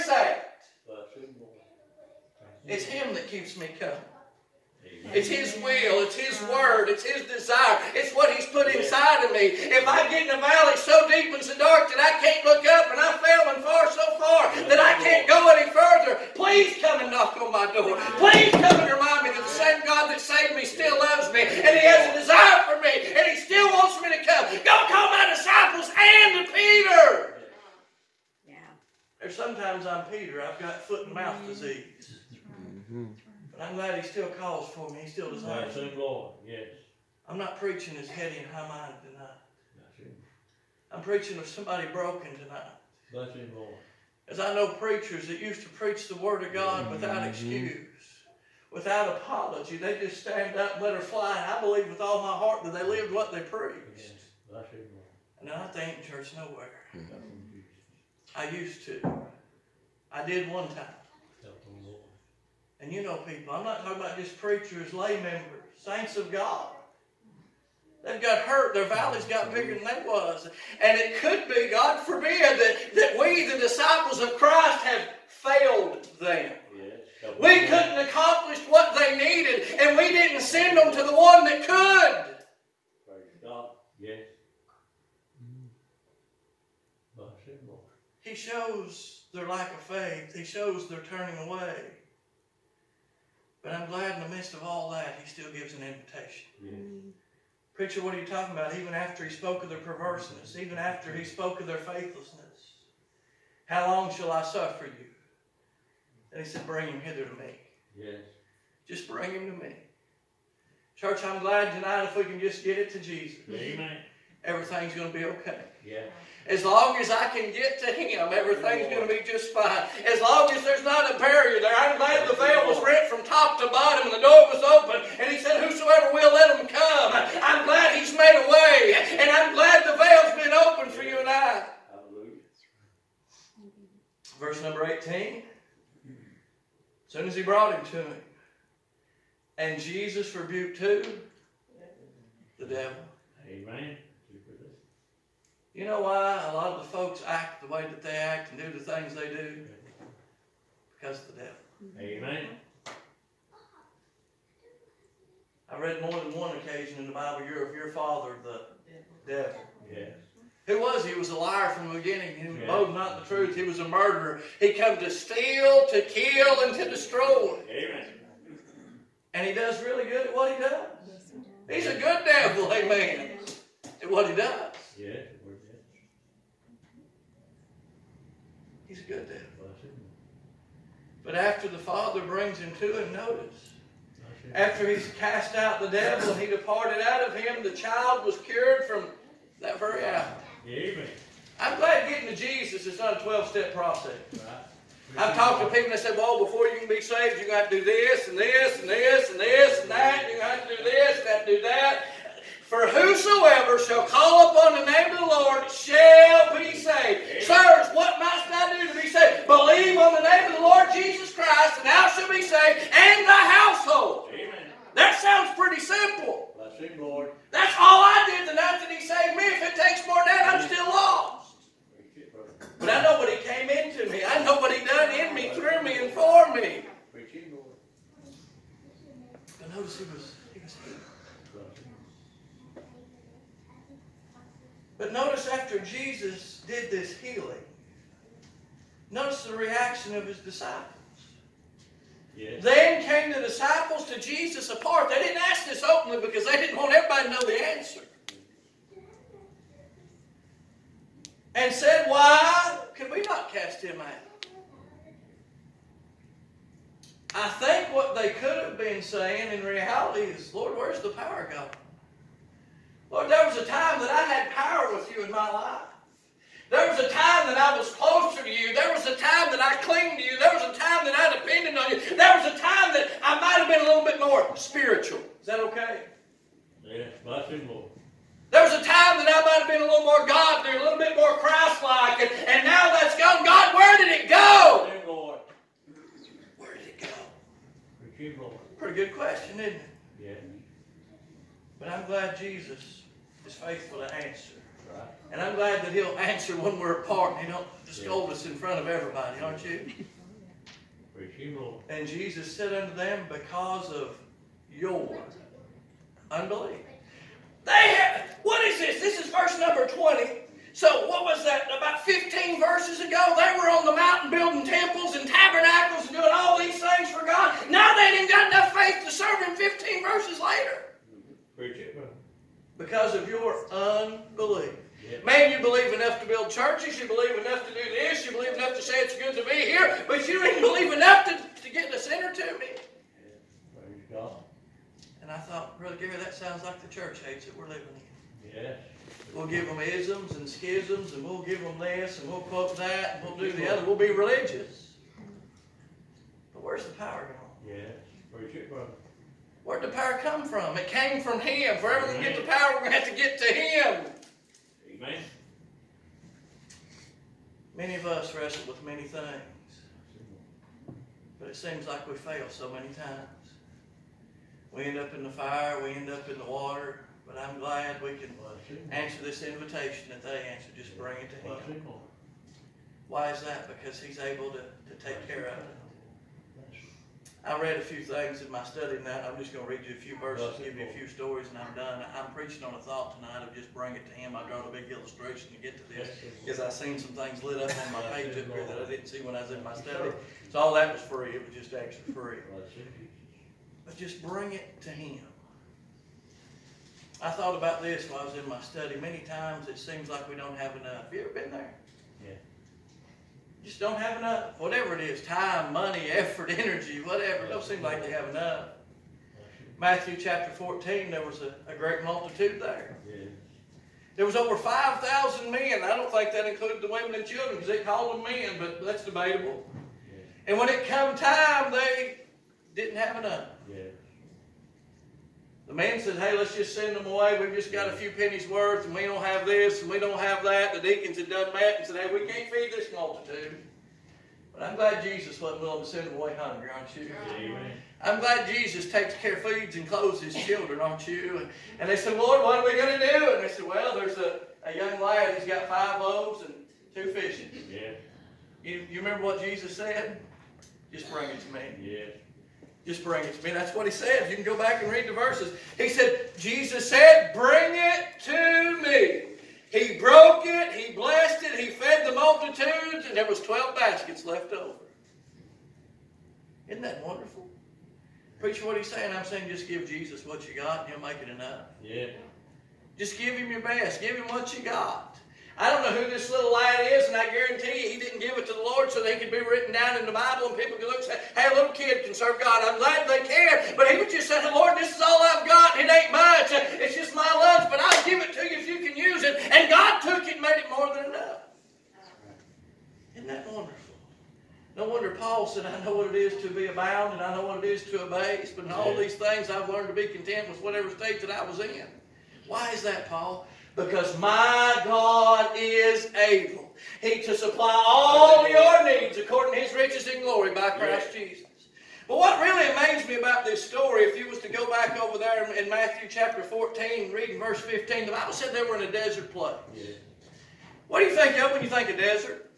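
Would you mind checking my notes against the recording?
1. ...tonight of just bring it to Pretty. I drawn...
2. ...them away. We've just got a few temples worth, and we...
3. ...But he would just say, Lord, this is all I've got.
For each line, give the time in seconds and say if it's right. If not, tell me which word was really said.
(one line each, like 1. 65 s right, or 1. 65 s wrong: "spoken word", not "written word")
1. 383 s wrong: "Him", not "Pretty"
2. 426 s wrong: "pennies", not "temples"
3. 483 s right.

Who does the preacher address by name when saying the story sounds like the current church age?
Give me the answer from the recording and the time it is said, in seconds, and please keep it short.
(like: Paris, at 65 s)
Brother Gary, at 335 s.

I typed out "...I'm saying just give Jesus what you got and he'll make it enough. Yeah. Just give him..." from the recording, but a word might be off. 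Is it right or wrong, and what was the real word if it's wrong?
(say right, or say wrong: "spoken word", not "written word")
right.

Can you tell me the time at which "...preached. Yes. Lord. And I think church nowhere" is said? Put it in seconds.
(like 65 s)
53 s.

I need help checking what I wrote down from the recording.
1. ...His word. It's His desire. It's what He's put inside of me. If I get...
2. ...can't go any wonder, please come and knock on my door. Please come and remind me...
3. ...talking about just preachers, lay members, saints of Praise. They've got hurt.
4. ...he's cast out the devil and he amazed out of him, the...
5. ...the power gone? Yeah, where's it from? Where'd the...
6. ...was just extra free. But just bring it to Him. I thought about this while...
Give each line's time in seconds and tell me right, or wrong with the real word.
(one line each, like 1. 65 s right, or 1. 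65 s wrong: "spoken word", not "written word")
1. 6 s right
2. 15 s wrong: "further", not "wonder"
3. 63 s wrong: "God", not "Praise"
4. 184 s wrong: "departed", not "amazed"
5. 346 s right
6. 391 s right.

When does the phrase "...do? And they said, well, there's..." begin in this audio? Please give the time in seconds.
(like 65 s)
443 s.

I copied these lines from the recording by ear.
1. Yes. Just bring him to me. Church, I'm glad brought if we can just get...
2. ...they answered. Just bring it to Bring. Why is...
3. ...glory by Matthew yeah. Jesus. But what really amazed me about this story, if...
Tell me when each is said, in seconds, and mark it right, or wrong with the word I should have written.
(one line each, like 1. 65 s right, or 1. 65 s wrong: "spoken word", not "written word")
1. 107 s wrong: "tonight", not "brought"
2. 370 s wrong: "Him", not "Bring"
3. 510 s wrong: "Christ", not "Matthew".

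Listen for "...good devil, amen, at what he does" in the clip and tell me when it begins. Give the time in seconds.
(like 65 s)
171 s.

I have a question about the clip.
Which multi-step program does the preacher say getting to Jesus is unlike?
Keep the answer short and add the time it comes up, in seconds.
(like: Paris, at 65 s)
12 step, at 193 s.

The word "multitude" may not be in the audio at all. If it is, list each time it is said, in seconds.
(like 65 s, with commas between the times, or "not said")
412 s, 432 s, 462 s.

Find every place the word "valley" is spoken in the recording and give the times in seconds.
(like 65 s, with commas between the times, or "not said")
10 s, 68 s.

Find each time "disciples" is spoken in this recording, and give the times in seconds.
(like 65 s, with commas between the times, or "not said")
25 s, 73 s.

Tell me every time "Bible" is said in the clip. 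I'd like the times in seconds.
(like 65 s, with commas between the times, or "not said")
157 s, 480 s, 518 s.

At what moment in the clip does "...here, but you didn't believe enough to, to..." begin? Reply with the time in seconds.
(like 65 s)
329 s.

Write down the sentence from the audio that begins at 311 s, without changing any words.
About 15 verses ago, they were on the mountain building temples and tabernacles and doing all these things for God.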